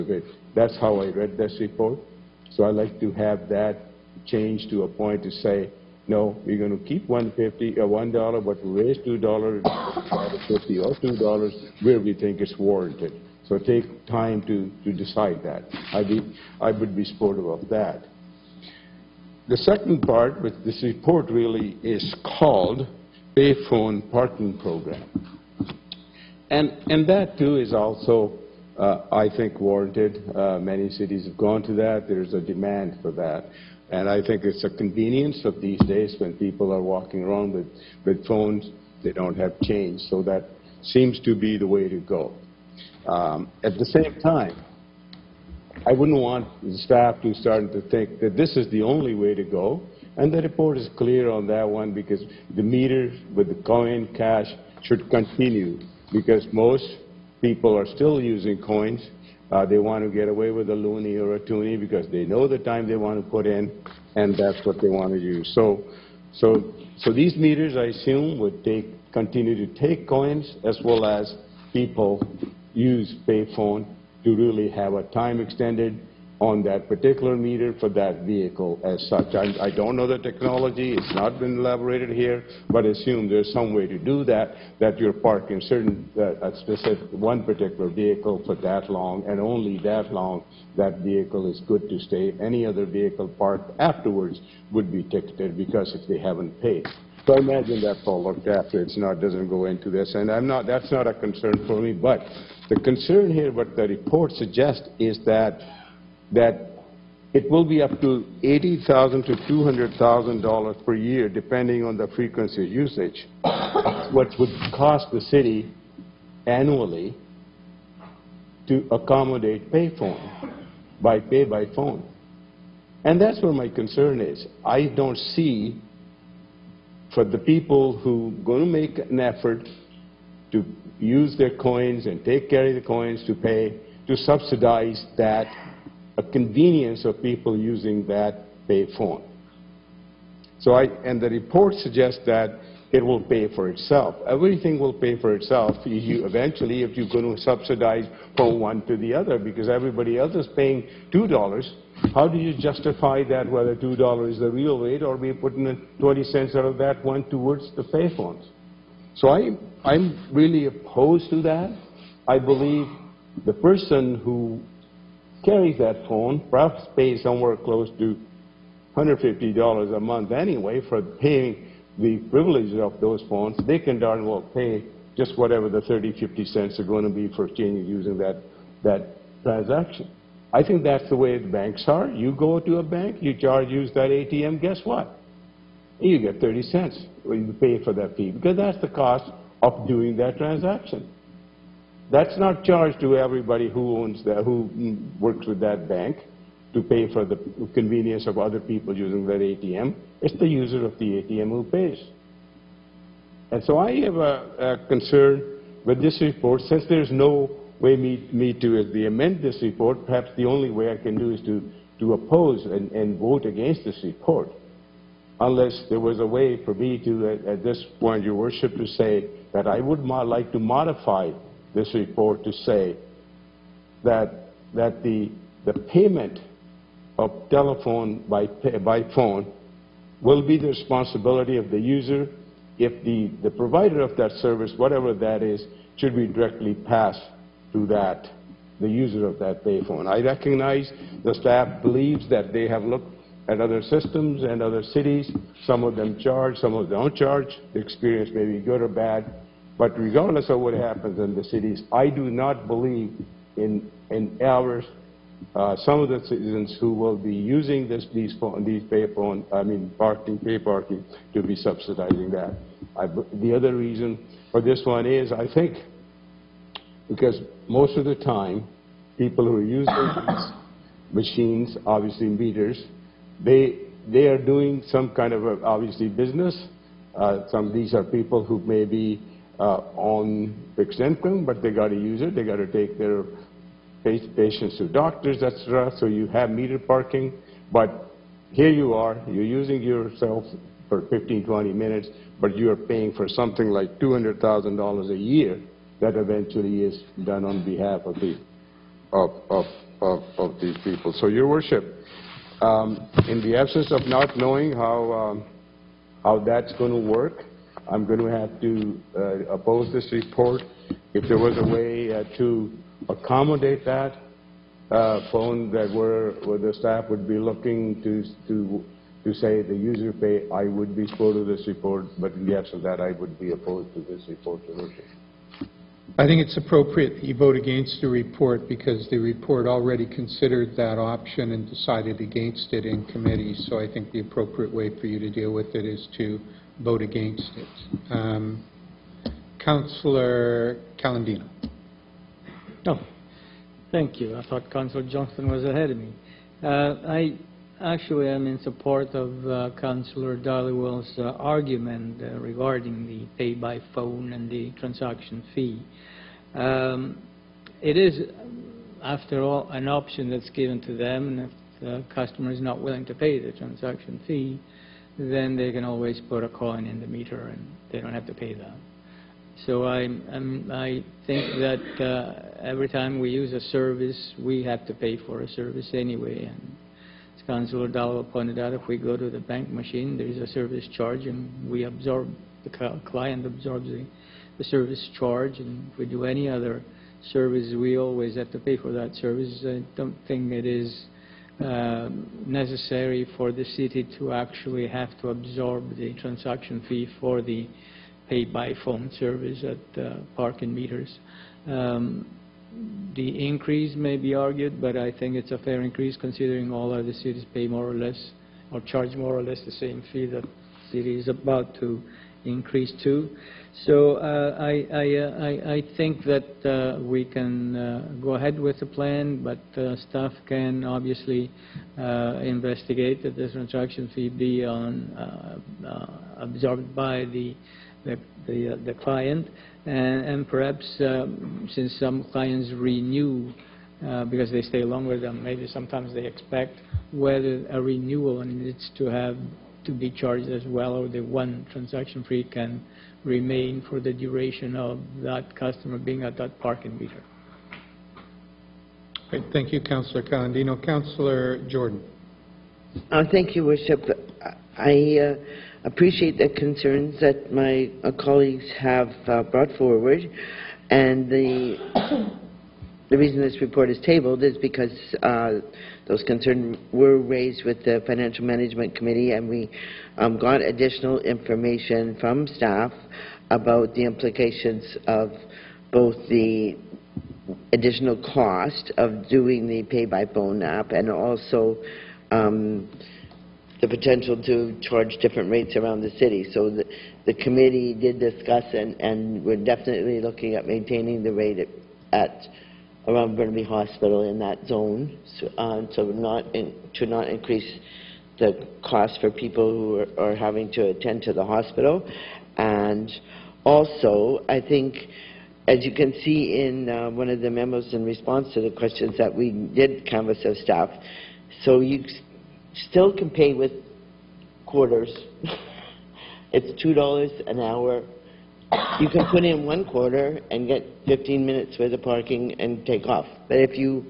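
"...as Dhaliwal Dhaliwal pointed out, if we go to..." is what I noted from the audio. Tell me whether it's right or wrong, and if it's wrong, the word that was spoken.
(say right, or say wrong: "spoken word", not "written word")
wrong: "Councillor", not "Dhaliwal".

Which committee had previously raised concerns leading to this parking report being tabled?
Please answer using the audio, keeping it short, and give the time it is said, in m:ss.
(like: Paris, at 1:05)
Financial Management Committee, at 7:48.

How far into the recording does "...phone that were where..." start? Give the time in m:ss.
5:15.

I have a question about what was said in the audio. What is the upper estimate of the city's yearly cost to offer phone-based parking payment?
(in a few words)
$200,000.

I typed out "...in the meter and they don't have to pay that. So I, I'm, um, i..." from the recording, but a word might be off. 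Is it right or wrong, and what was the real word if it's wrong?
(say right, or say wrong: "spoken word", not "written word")
right.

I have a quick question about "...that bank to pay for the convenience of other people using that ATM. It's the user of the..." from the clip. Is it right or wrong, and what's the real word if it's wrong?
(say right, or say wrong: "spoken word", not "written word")
right.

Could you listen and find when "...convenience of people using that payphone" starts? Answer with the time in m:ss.
2:16.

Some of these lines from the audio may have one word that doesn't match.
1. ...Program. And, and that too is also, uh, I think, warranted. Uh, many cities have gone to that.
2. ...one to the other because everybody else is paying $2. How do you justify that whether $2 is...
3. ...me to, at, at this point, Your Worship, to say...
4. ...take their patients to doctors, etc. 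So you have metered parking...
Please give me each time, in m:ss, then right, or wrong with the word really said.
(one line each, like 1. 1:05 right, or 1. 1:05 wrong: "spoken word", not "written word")
1. 0:24 right
2. 2:28 right
3. 3:36 right
4. 4:42 right.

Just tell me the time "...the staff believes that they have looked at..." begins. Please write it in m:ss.
4:01.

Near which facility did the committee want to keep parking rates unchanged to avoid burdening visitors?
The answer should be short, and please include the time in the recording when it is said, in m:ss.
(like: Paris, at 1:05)
Burnaby Hospital, at 8:13.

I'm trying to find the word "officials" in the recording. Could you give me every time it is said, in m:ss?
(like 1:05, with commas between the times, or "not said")
not said.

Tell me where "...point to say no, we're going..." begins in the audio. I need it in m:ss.
0:04.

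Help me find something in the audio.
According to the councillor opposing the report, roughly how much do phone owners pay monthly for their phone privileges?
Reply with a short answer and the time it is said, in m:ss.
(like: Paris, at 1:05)
$150, at 2:48.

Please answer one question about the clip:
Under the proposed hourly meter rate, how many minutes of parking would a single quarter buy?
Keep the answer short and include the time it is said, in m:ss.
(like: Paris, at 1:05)
15 minutes, at 8:41.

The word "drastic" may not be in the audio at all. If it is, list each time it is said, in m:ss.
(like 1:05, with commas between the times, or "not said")
not said.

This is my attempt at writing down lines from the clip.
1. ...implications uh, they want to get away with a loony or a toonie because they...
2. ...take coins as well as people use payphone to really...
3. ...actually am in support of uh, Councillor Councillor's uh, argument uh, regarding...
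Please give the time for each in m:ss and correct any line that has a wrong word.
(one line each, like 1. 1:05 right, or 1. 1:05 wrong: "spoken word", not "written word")
1. 0:58 wrong: "coins", not "implications"
2. 1:09 right
3. 5:47 wrong: "Dhaliwal", not "Councillor".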